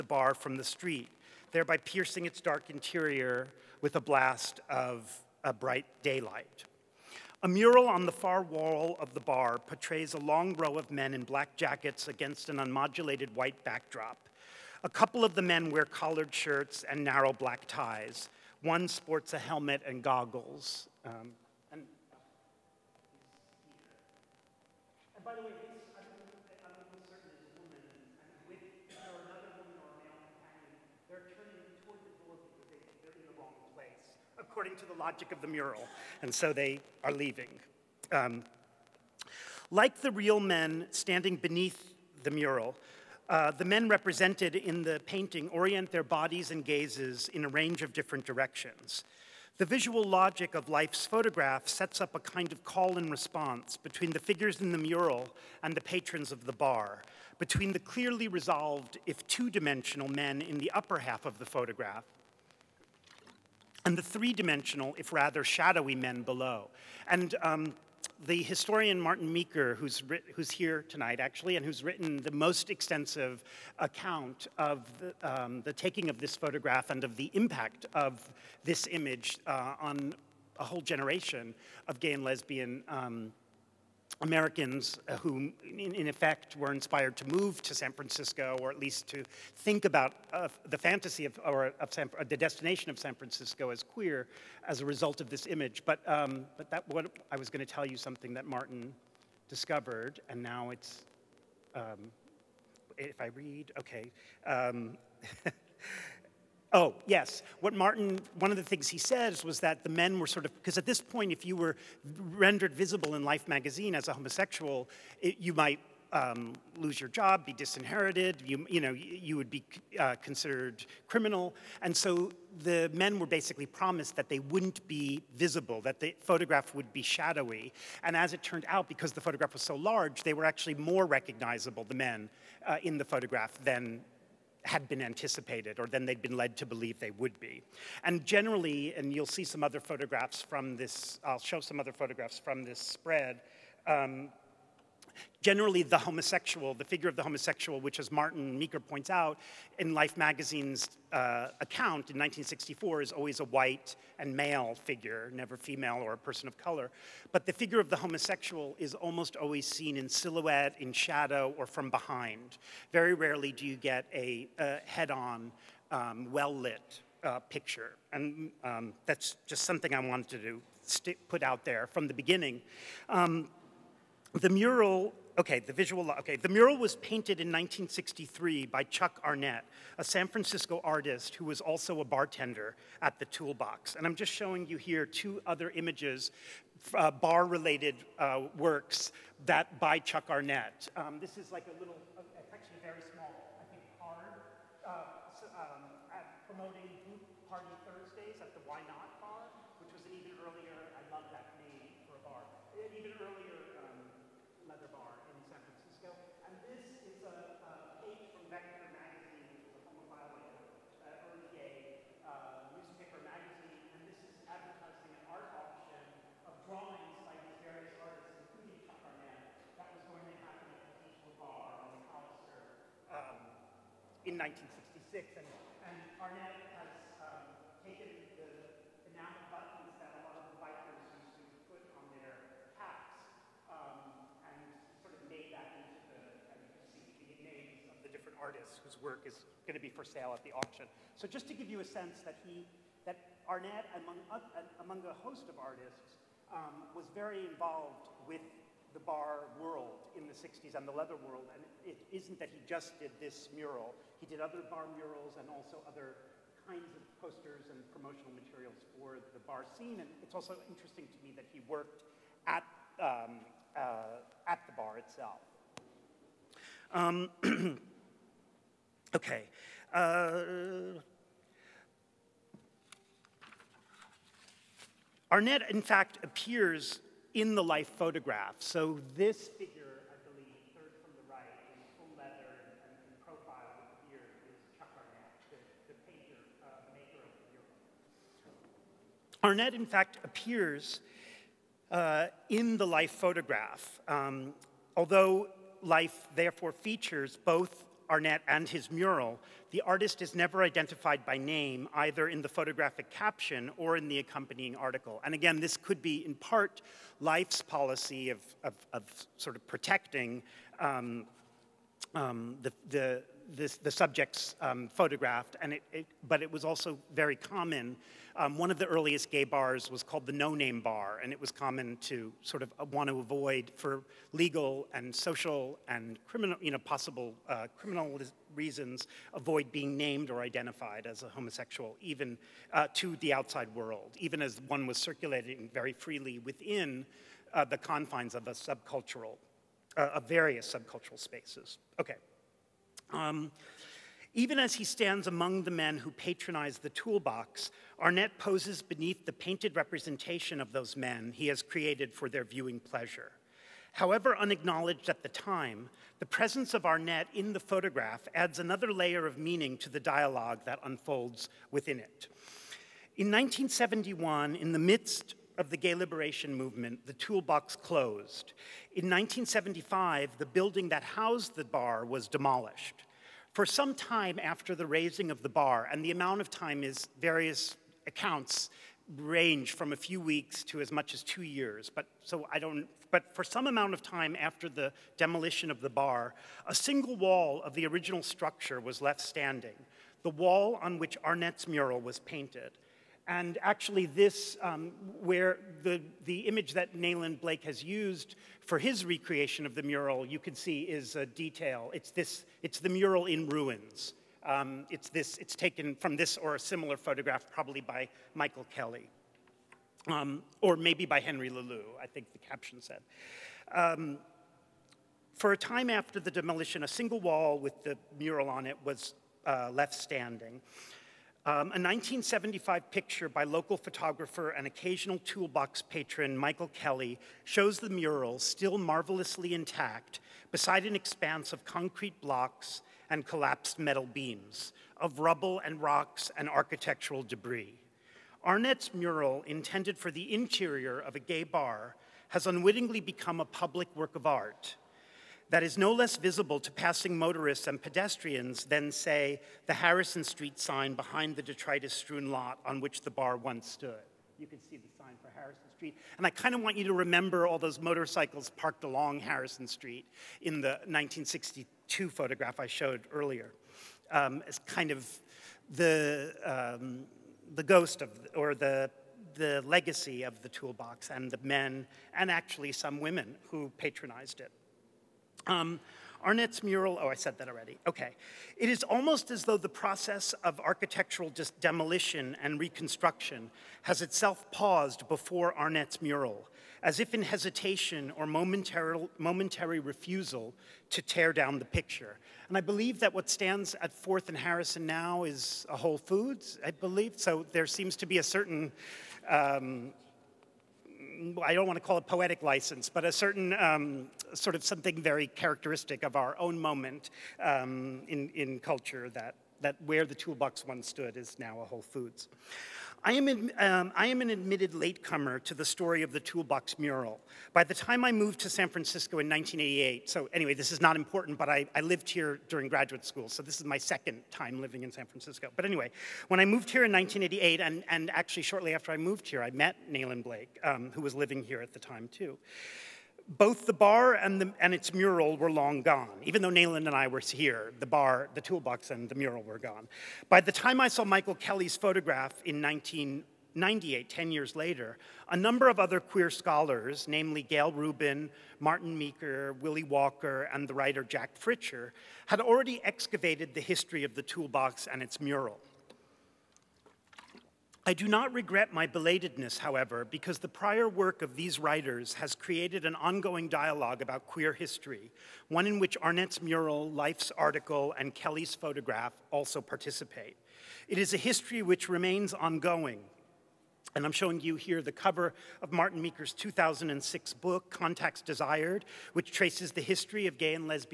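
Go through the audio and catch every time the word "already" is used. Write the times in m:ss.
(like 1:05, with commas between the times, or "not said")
7:57, 9:12.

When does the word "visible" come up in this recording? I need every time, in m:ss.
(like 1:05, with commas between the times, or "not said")
1:52, 2:05, 7:26.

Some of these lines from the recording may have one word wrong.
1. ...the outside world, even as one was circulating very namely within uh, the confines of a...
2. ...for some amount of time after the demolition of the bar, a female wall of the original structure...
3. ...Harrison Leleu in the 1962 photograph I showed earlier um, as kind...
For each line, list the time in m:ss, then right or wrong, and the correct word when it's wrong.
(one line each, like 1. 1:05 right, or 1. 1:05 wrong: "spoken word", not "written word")
1. 5:33 wrong: "freely", not "namely"
2. 6:23 wrong: "single", not "female"
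3. 7:39 wrong: "Street", not "Leleu".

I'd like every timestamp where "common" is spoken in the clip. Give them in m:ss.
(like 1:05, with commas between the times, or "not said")
5:17, 5:21.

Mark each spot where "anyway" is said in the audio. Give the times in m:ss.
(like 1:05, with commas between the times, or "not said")
8:40, 8:45.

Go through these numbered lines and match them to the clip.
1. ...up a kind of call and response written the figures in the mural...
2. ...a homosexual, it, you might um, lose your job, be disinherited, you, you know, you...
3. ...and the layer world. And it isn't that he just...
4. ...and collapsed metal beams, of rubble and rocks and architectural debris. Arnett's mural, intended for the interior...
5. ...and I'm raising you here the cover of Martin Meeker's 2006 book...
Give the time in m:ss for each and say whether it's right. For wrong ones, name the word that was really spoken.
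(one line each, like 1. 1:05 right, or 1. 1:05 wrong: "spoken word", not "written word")
1. 0:52 wrong: "between", not "written"
2. 1:54 right
3. 4:10 wrong: "leather", not "layer"
4. 7:13 right
5. 9:33 wrong: "showing", not "raising".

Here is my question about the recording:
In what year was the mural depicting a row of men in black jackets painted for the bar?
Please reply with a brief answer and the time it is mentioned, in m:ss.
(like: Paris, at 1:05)
1963, at 2:57.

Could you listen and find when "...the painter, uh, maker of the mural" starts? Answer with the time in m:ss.
4:45.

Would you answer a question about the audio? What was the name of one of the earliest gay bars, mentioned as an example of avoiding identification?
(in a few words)
No Name Bar.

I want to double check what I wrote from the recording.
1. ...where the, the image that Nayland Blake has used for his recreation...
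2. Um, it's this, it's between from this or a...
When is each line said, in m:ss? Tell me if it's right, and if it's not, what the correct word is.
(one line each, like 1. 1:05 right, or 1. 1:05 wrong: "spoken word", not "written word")
1. 6:35 right
2. 6:44 wrong: "taken", not "between".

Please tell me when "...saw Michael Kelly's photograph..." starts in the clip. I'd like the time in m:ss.
9:00.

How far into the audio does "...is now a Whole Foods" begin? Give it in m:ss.
8:31.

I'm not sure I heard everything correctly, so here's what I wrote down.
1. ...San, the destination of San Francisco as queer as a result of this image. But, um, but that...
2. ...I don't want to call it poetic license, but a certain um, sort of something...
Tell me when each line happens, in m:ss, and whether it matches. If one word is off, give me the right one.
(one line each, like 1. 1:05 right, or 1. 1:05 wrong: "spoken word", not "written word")
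1. 1:31 right
2. 8:21 right.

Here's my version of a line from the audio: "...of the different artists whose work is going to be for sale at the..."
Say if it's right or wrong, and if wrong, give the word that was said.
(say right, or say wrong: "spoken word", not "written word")
right.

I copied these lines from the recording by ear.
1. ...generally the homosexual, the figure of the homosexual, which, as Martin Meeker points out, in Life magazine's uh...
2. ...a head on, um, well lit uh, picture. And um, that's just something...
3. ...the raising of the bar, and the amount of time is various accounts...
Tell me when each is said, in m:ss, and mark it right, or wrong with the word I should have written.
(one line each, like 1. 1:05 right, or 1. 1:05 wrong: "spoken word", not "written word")
1. 2:25 right
2. 2:44 right
3. 6:14 right.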